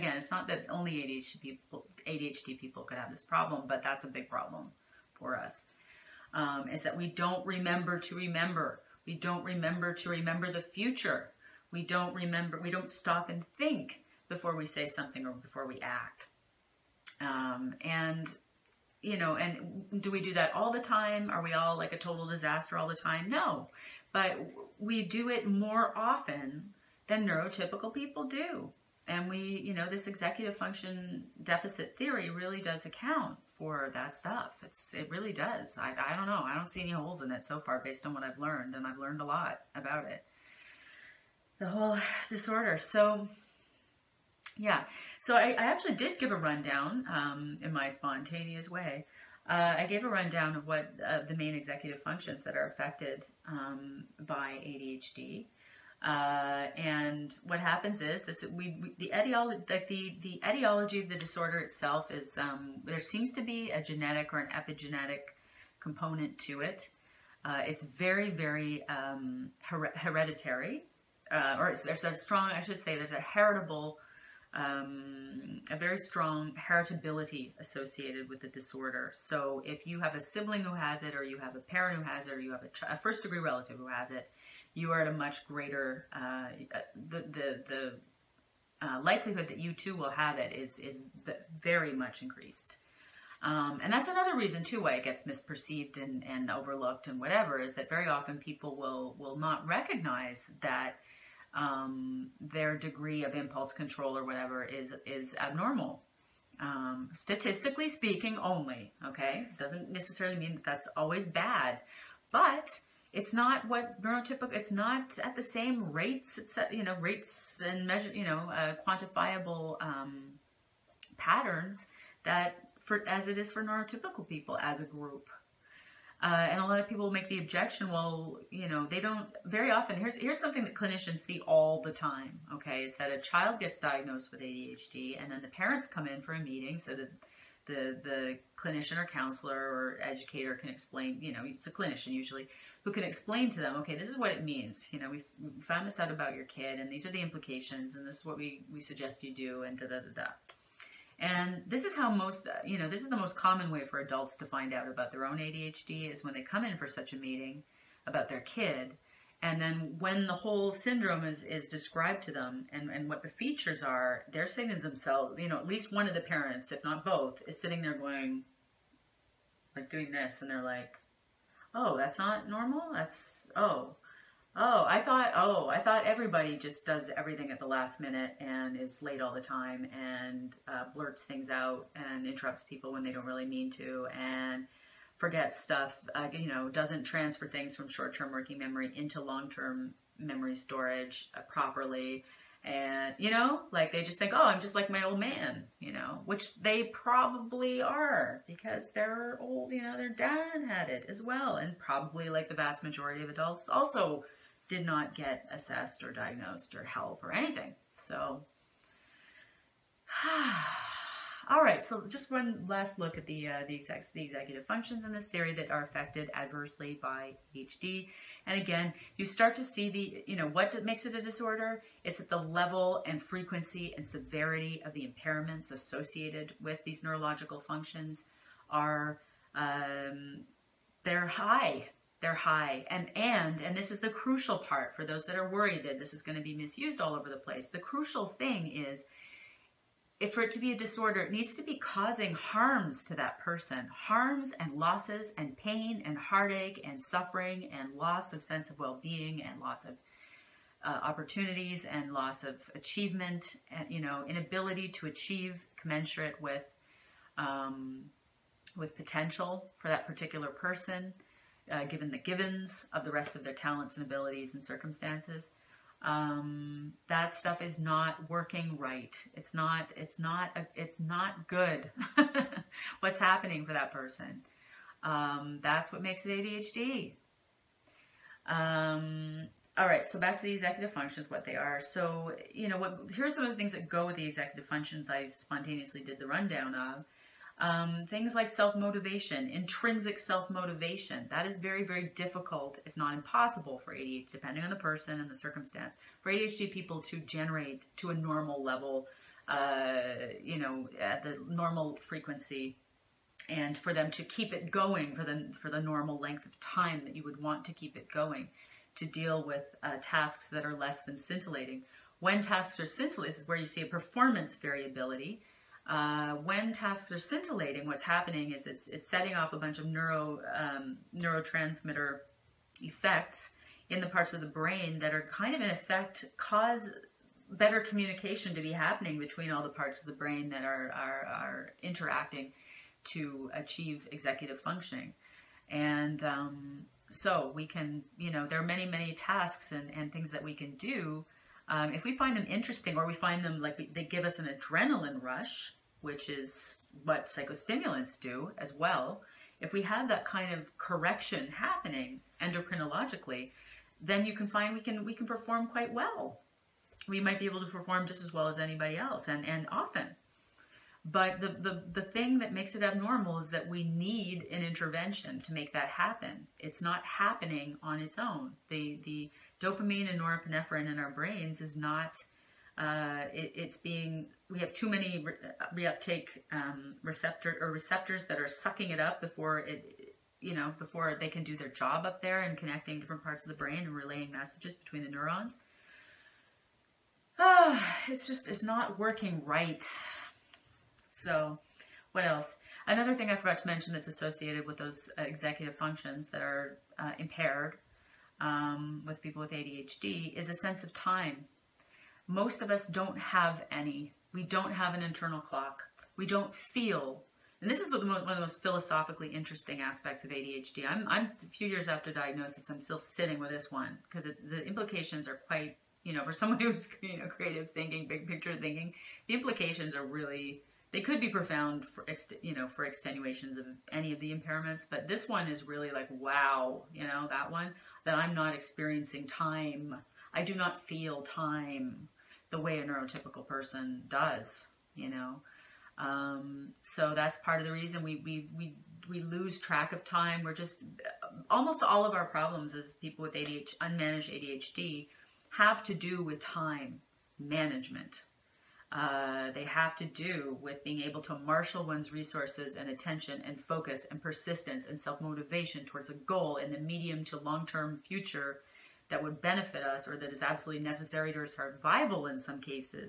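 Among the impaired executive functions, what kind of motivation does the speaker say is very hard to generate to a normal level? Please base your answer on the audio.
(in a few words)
intrinsic self-motivation.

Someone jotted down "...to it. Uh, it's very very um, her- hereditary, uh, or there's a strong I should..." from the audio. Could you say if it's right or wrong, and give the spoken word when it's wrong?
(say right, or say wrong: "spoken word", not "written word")
right.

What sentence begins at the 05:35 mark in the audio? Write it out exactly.
And um, so we can, you know, there are many, many tasks and, and things that we can do.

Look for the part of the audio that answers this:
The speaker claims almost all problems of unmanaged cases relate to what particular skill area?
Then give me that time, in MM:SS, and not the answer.
07:26.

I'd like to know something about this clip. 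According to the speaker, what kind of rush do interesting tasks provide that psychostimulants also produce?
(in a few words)
an adrenaline rush.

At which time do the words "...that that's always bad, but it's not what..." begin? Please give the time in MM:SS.
01:50.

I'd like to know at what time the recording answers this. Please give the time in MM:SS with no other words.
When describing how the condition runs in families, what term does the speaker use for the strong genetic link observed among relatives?
01:16.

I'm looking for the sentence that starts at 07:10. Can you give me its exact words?
I do not feel time the way a neurotypical person does, you know.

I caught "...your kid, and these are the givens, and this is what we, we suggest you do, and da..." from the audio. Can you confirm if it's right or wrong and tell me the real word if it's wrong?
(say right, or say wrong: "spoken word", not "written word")
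wrong: "implications", not "givens".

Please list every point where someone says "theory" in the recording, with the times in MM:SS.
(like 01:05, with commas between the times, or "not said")
00:31, 03:35.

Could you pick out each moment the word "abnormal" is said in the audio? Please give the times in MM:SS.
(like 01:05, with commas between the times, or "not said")
01:45, 06:02.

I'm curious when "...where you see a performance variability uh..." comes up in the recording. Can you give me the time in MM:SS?
05:13.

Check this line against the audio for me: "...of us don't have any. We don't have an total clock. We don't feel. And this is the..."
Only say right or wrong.
wrong.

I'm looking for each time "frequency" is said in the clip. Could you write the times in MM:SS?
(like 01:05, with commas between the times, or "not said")
03:43, 05:02.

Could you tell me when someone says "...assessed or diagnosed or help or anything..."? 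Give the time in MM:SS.
03:25.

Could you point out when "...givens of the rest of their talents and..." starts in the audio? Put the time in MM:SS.
04:22.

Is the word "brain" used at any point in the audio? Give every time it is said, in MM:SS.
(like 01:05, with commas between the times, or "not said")
05:24, 05:30, 06:11, 06:23.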